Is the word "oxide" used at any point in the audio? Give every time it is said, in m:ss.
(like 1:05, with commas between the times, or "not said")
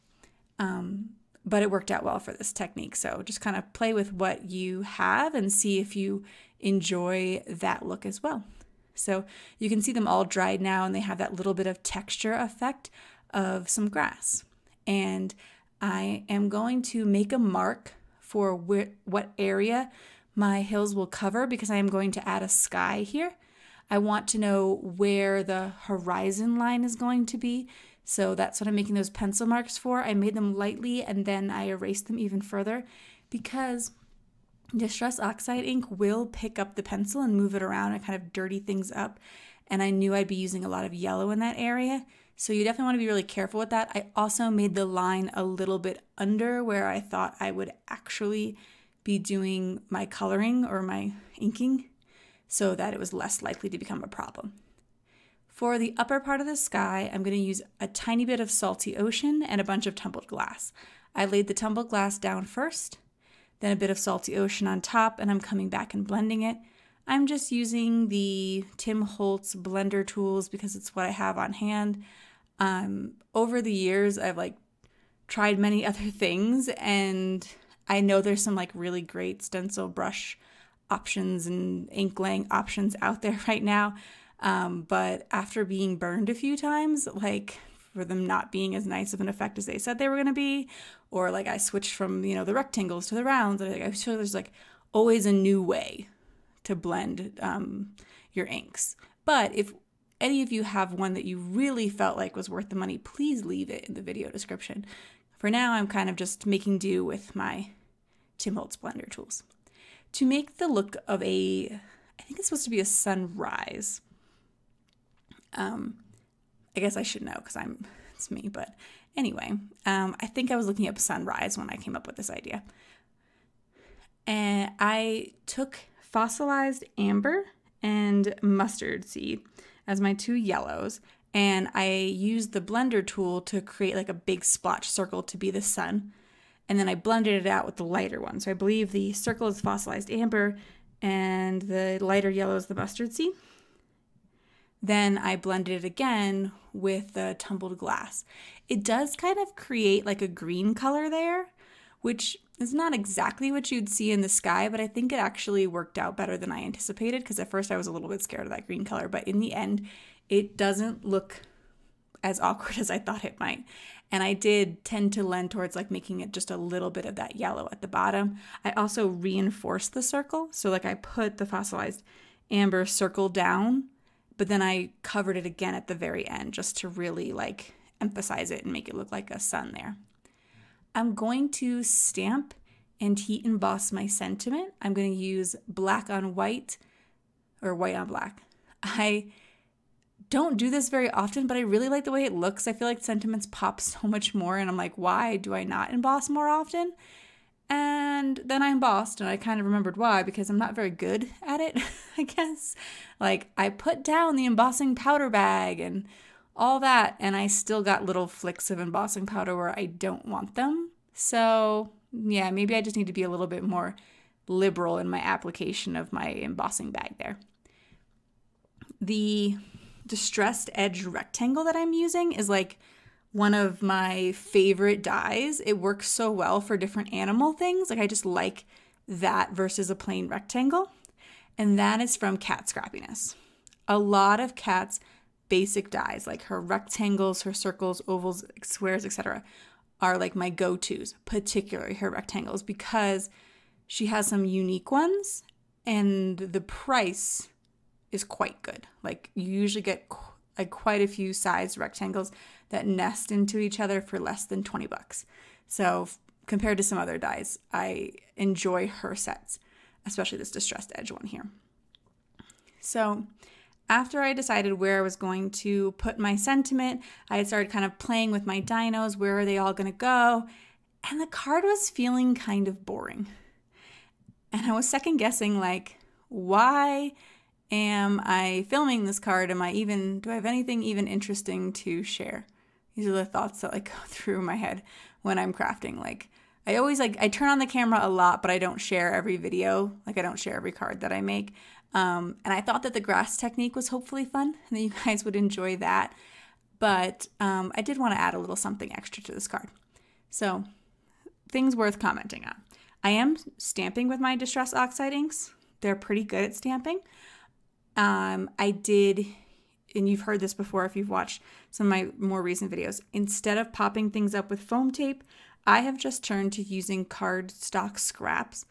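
0:35, 5:04.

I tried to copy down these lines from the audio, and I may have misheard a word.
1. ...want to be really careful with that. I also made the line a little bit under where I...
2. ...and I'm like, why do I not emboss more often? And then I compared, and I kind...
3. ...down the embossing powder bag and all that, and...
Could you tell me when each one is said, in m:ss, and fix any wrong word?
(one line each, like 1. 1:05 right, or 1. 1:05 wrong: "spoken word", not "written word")
1. 0:42 right
2. 3:14 wrong: "embossed", not "compared"
3. 3:24 right.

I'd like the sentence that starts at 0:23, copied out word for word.
I want to know where the horizon line is going to be so that's what I'm making those pencil marks for.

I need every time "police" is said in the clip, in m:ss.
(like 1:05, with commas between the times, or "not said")
not said.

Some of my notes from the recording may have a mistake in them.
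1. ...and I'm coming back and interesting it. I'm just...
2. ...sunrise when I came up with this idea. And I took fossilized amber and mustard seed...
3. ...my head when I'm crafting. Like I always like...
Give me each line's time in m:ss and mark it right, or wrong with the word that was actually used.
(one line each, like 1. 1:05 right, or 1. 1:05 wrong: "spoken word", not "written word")
1. 1:05 wrong: "blending", not "interesting"
2. 2:00 right
3. 4:44 right.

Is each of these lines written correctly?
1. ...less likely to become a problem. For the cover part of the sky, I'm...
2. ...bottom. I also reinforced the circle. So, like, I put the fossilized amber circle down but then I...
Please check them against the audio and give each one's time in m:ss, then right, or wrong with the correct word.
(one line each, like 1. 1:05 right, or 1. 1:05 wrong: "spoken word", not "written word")
1. 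0:53 wrong: "upper", not "cover"
2. 2:47 right.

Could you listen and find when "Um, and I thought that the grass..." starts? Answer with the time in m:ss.
4:51.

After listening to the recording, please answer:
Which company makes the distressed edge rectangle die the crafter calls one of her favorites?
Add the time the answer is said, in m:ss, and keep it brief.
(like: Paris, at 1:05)
Kat Scrappiness, at 3:52.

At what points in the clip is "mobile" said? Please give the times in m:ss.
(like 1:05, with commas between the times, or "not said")
not said.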